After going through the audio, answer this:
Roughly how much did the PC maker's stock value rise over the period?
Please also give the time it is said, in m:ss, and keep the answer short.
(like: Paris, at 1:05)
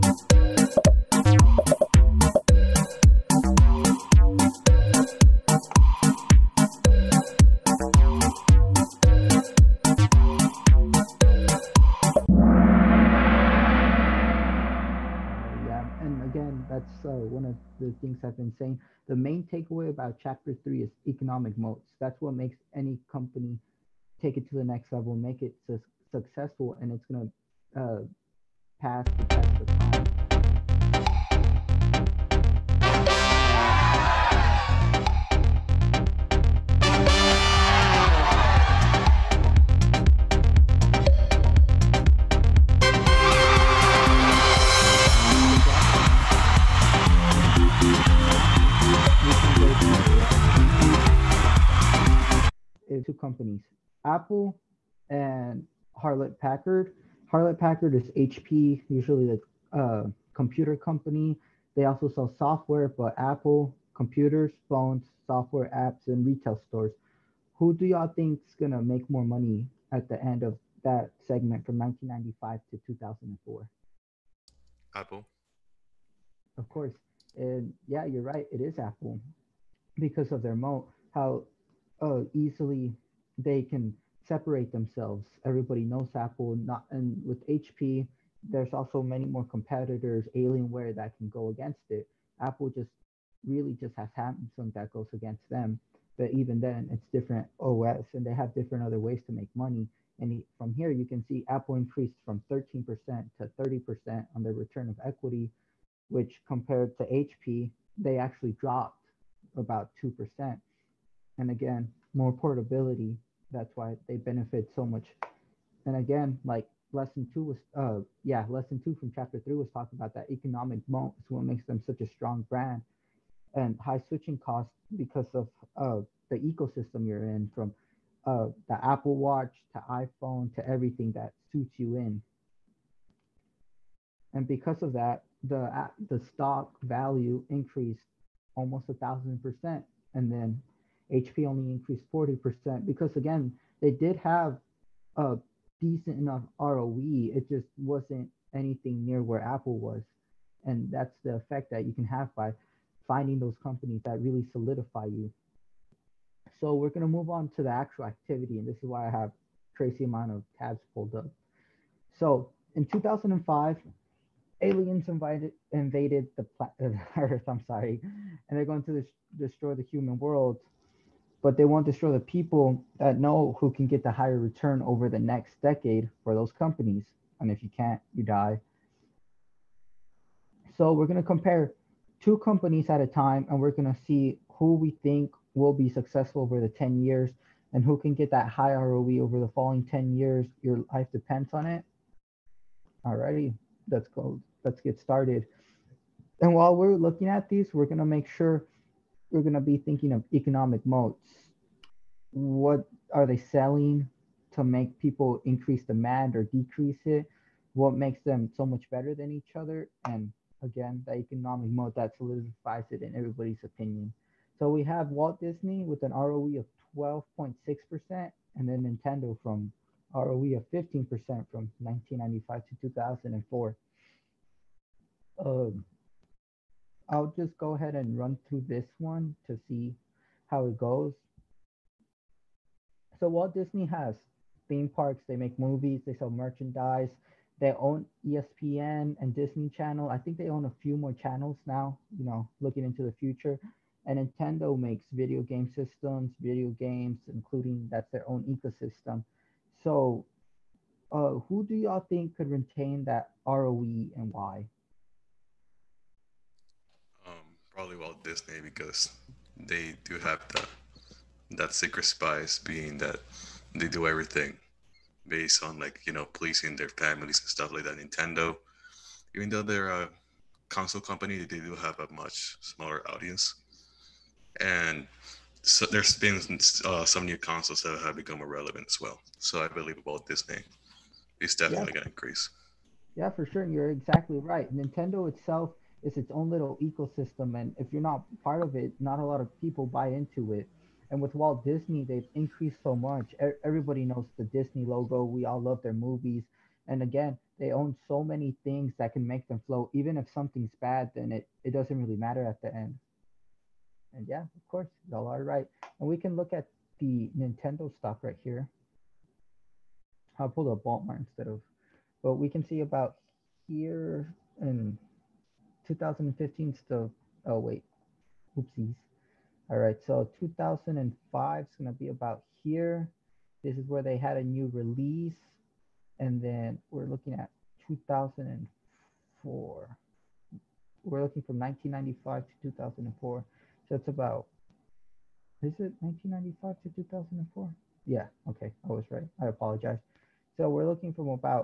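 40%, at 2:22.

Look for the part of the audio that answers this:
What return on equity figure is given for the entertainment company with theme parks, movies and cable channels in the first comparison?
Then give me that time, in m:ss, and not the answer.
3:36.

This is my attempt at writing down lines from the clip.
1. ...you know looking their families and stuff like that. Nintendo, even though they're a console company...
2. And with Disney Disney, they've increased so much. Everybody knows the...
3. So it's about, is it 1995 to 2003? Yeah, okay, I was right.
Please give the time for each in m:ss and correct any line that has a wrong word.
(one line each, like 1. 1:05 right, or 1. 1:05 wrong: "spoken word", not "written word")
1. 4:26 wrong: "pleasing", not "looking"
2. 4:51 wrong: "Walt", not "Disney"
3. 5:33 wrong: "2004", not "2003".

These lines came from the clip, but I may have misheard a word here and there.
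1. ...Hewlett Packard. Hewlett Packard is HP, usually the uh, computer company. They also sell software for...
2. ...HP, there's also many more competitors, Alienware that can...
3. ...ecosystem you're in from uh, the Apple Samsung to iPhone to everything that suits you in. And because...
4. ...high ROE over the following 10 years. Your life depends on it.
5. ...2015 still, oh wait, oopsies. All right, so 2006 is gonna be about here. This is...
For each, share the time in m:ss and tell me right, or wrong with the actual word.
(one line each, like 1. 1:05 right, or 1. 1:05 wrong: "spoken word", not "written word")
1. 0:56 right
2. 1:27 right
3. 2:06 wrong: "Watch", not "Samsung"
4. 3:08 right
5. 5:15 wrong: "2005", not "2006".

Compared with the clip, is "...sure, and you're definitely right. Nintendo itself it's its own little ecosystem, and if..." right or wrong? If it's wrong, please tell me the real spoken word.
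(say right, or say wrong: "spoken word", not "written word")
wrong: "exactly", not "definitely".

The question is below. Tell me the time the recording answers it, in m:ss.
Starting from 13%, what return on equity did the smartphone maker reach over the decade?
1:43.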